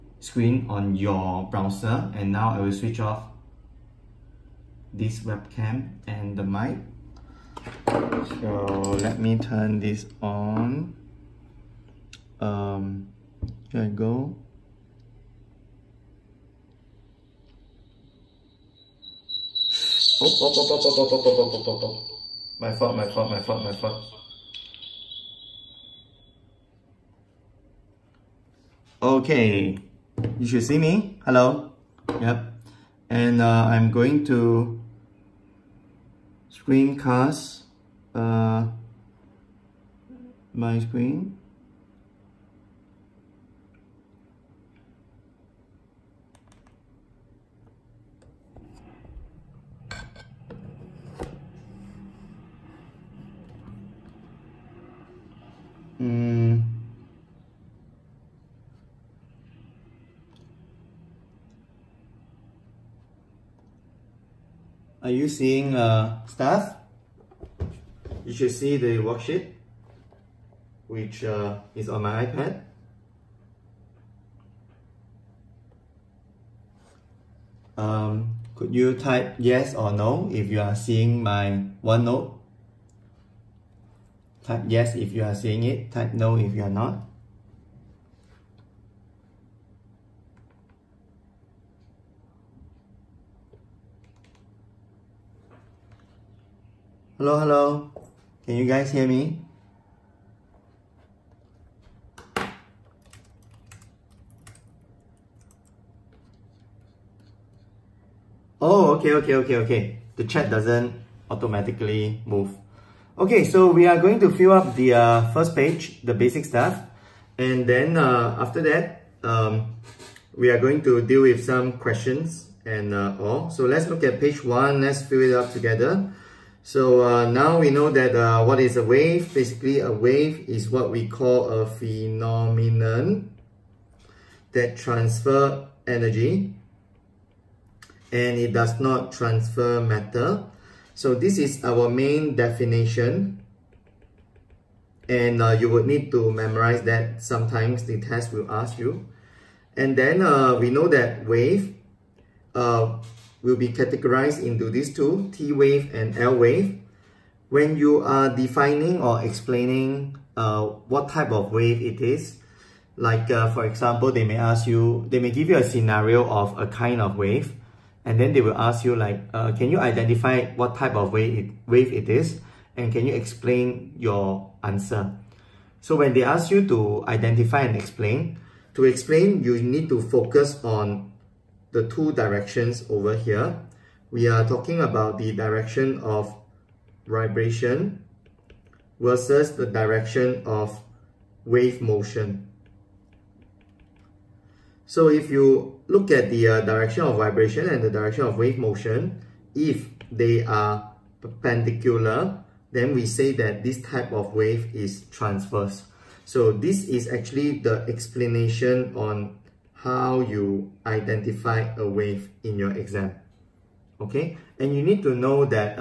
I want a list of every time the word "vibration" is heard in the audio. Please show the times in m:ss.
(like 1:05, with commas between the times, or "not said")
3:07, 3:17.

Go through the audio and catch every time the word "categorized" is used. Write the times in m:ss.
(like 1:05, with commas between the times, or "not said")
2:33.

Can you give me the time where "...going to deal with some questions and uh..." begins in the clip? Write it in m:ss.
2:00.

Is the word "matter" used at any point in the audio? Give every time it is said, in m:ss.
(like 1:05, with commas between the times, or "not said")
2:19.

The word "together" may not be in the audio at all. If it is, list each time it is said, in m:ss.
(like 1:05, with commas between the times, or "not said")
2:05.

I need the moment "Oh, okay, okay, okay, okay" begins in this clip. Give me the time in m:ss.
1:48.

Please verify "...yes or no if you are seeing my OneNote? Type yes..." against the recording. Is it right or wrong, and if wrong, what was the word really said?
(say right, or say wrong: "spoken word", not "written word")
right.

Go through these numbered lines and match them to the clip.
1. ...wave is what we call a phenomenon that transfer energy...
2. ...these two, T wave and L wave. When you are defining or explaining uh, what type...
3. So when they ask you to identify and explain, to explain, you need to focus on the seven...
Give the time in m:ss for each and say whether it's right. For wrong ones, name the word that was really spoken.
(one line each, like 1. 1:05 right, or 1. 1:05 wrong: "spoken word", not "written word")
1. 2:09 right
2. 2:34 right
3. 2:55 wrong: "two", not "seven".